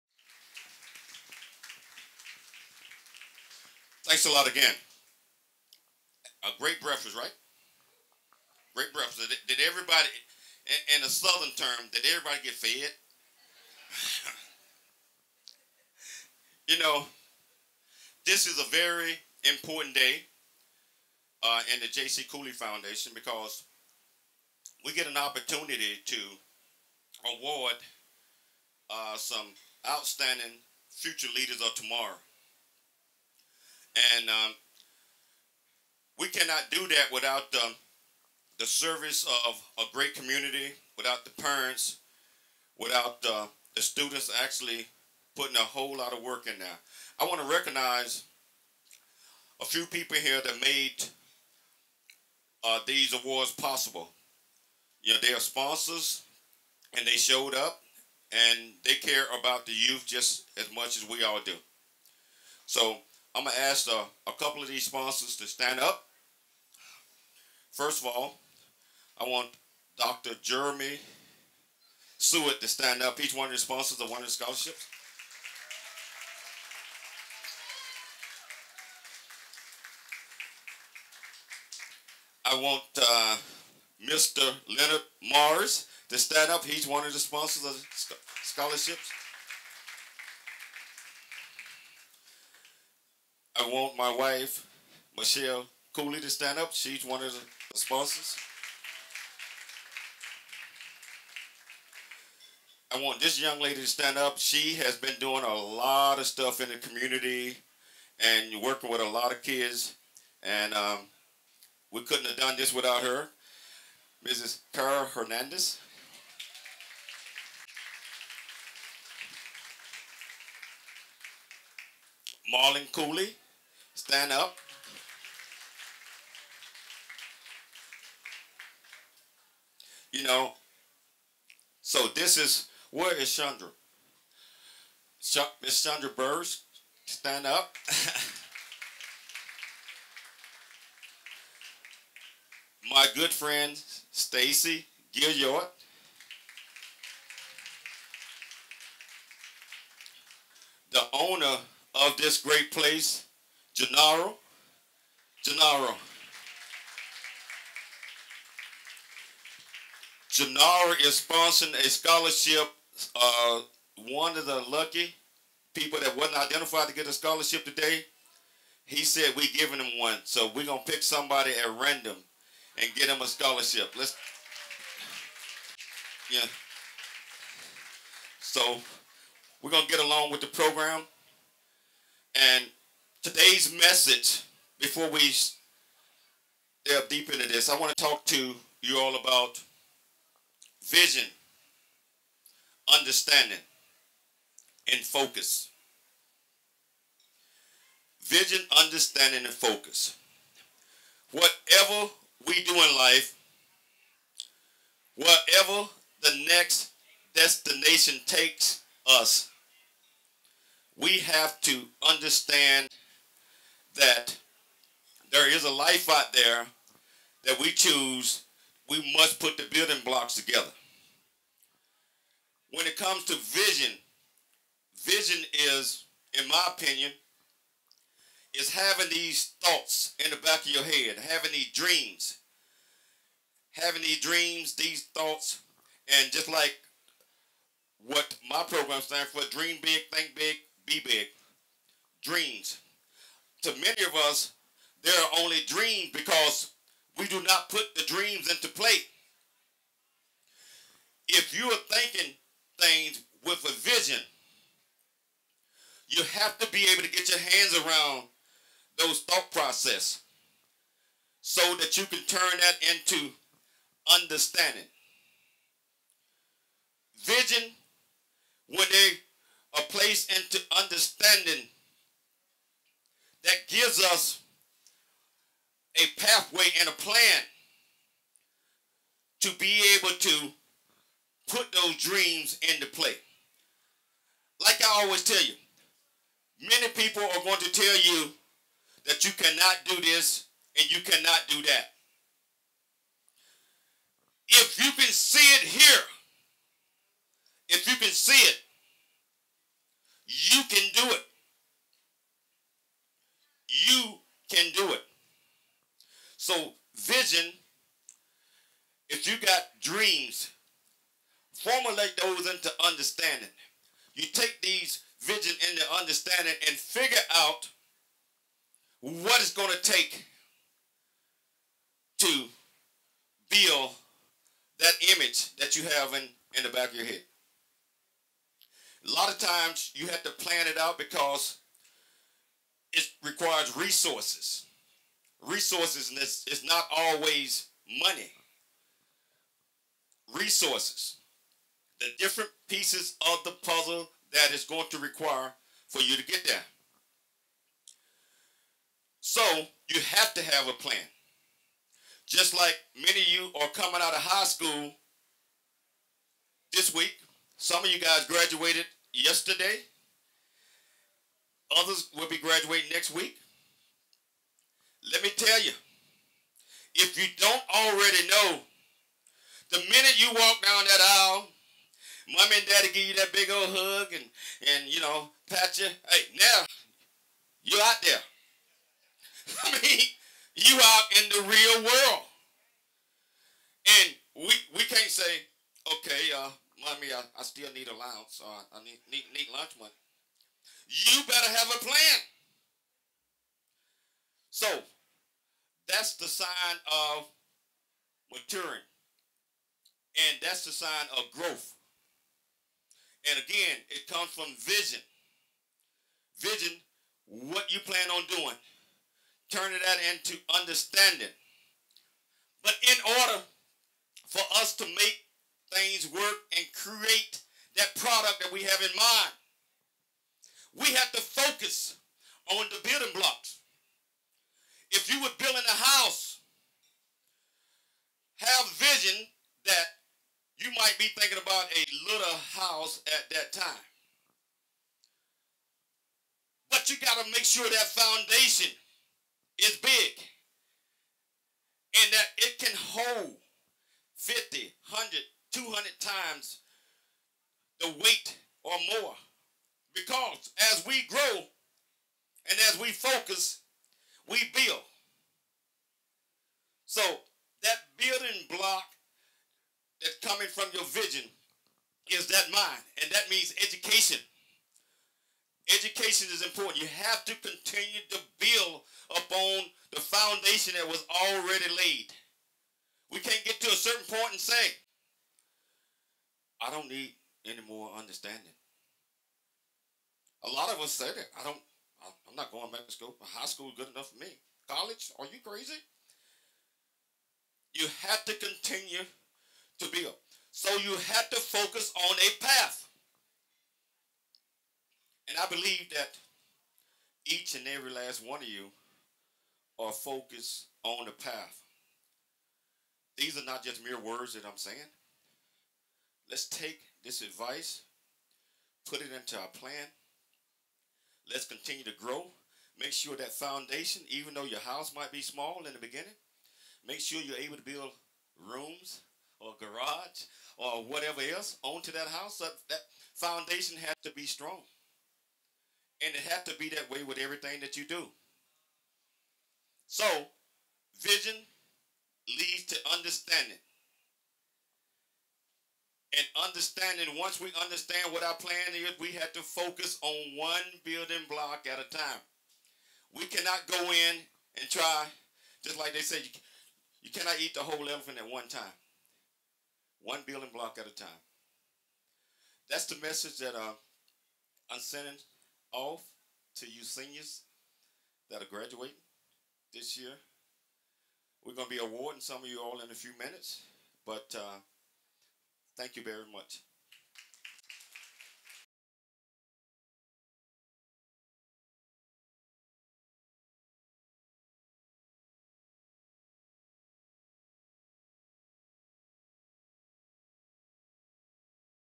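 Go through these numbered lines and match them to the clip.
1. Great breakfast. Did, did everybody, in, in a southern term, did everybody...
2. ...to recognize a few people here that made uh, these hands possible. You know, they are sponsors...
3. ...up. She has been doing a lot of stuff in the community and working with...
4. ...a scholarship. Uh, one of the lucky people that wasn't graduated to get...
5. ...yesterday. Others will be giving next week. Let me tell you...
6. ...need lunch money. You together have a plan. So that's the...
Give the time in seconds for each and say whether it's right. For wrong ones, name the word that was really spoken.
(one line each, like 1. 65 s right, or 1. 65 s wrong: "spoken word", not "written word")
1. 8 s right
2. 47 s wrong: "awards", not "hands"
3. 104 s right
4. 161 s wrong: "identified", not "graduated"
5. 359 s wrong: "graduating", not "giving"
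6. 389 s wrong: "better", not "together".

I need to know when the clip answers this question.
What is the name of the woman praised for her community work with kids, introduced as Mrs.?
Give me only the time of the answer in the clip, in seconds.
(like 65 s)
114 s.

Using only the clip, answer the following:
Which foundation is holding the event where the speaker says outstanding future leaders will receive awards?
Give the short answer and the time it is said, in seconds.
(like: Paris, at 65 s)
J.C. Cooley Foundation, at 21 s.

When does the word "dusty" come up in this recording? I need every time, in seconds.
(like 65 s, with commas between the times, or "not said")
not said.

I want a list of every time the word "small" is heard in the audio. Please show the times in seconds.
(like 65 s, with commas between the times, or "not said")
515 s.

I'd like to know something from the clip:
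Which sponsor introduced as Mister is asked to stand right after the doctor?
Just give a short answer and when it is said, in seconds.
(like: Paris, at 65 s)
Leonard Mars, at 84 s.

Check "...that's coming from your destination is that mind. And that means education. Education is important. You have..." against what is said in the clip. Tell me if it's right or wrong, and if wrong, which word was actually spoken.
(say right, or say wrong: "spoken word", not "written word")
wrong: "vision", not "destination".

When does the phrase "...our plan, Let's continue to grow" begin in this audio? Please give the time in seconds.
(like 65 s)
509 s.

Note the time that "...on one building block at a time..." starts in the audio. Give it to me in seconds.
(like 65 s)
540 s.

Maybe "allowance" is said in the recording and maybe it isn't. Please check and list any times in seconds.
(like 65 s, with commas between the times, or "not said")
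387 s.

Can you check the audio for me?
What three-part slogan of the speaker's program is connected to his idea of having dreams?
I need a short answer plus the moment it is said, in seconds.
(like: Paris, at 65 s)
dream big, think big, be big, at 239 s.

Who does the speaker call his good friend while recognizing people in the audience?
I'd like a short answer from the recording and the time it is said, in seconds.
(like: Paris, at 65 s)
Stacy Gilliard, at 144 s.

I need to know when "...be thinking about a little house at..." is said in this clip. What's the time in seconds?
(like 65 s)
430 s.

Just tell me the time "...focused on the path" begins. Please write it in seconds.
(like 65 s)
499 s.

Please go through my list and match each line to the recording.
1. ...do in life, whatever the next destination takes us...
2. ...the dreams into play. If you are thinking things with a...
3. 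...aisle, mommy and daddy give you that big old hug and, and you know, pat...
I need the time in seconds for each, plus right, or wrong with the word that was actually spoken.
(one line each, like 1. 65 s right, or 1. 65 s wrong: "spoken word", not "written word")
1. 202 s right
2. 247 s right
3. 371 s right.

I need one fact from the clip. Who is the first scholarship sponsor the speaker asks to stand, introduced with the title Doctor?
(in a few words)
Jeremy Seward.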